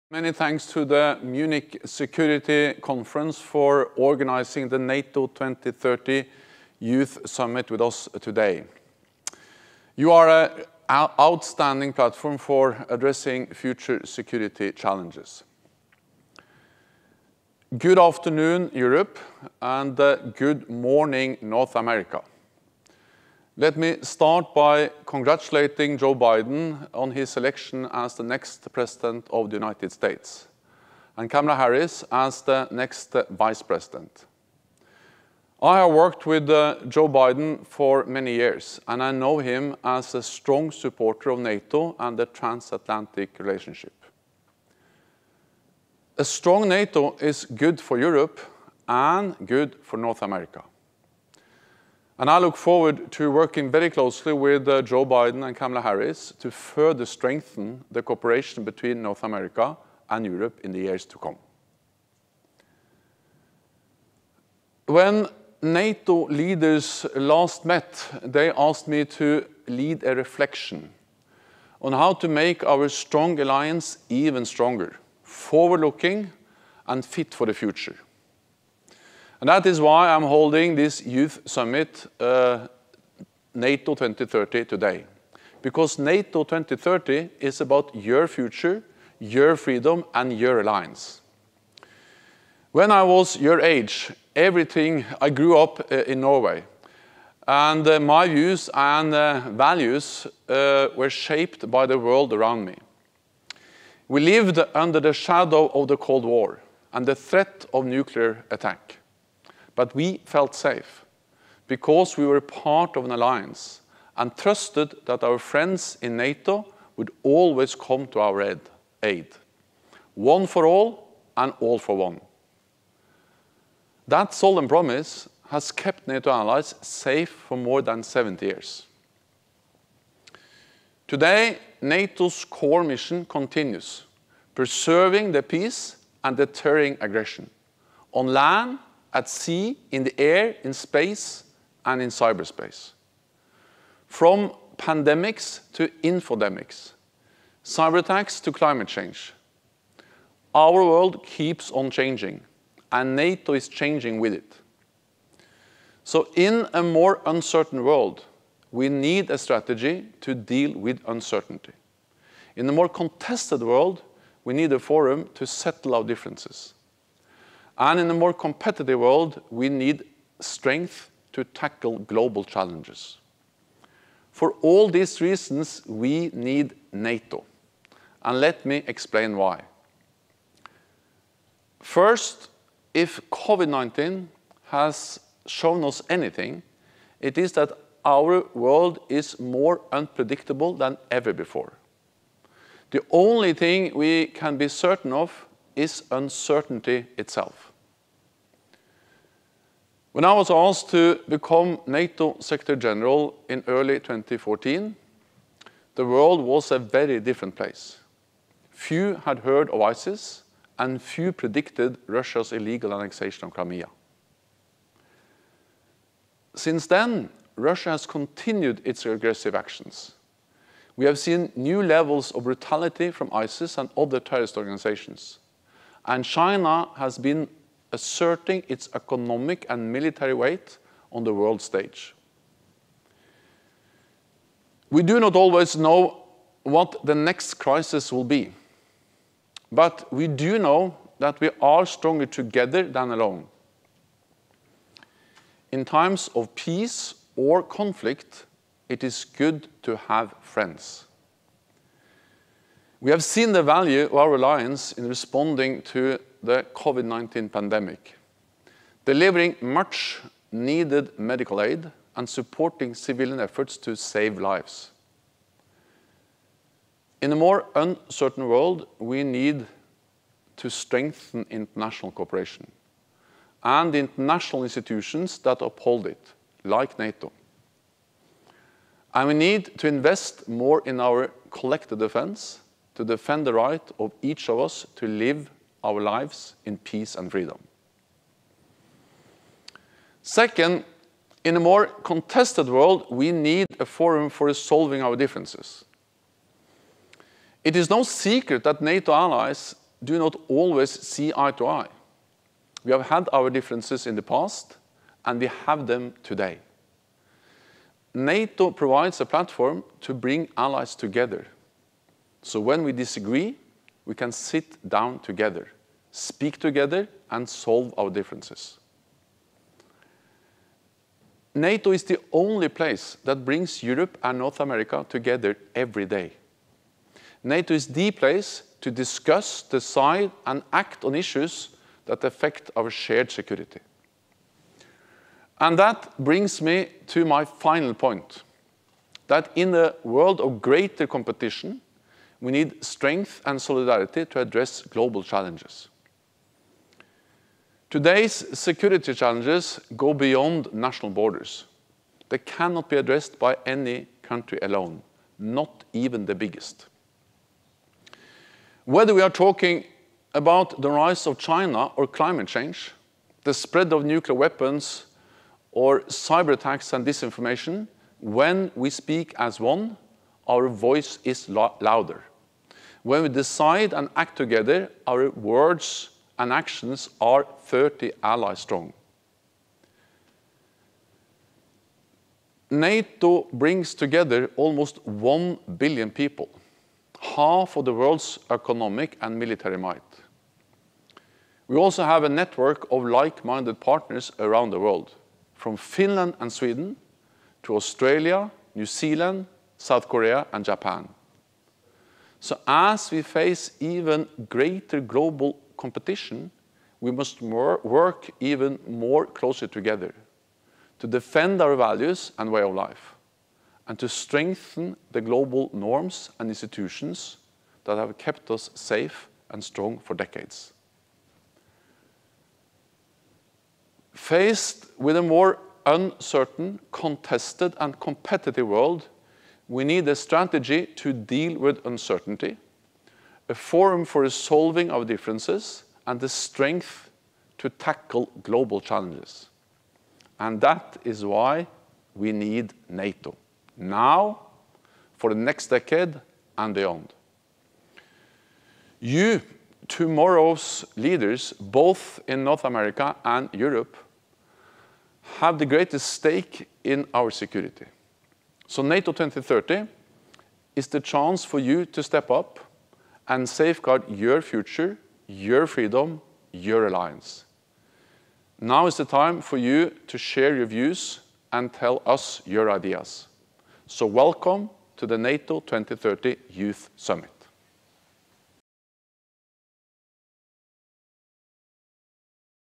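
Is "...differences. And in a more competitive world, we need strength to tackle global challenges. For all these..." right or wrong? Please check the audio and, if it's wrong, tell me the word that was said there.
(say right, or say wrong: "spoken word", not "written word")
right.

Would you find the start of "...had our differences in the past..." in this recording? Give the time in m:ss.
5:03.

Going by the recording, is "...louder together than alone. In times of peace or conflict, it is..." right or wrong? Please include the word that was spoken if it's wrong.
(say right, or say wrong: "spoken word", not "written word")
wrong: "stronger", not "louder".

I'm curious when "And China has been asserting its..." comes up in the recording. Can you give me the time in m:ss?
3:46.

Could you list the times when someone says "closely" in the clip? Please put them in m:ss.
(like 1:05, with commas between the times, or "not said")
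0:53, 6:49.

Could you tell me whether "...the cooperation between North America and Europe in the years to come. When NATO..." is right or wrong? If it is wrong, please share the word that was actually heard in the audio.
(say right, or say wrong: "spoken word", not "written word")
right.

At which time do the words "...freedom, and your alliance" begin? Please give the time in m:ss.
1:29.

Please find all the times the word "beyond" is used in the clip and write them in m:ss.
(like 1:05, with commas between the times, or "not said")
5:50, 7:26.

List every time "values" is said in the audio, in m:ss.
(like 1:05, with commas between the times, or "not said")
1:39, 4:13, 6:51.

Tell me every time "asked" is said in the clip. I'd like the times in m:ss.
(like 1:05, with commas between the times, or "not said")
1:08, 3:20.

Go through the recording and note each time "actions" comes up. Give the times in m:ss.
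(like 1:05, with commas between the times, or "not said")
3:39, 6:16.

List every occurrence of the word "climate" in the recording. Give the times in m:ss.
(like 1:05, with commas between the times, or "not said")
2:28, 6:02.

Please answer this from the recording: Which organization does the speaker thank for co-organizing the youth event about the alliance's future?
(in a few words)
Munich Security Conference.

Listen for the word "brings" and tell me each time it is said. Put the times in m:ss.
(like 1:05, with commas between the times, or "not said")
5:10, 5:23, 5:36, 6:23.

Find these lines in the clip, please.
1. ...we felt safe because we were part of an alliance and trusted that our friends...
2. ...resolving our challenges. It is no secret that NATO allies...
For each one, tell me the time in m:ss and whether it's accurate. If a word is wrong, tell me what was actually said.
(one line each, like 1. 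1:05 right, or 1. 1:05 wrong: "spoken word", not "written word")
1. 1:49 right
2. 4:54 wrong: "differences", not "challenges".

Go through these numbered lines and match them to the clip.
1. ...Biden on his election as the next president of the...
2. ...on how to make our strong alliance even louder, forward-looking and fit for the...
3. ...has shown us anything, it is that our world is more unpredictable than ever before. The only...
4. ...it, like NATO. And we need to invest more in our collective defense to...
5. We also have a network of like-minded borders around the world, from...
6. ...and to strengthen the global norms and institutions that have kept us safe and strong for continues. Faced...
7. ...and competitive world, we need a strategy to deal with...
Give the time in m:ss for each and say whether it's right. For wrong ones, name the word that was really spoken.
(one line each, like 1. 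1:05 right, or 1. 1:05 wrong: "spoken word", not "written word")
1. 0:26 right
2. 1:11 wrong: "stronger", not "louder"
3. 3:04 right
4. 4:36 right
5. 6:31 wrong: "partners", not "borders"
6. 6:53 wrong: "decades", not "continues"
7. 7:07 right.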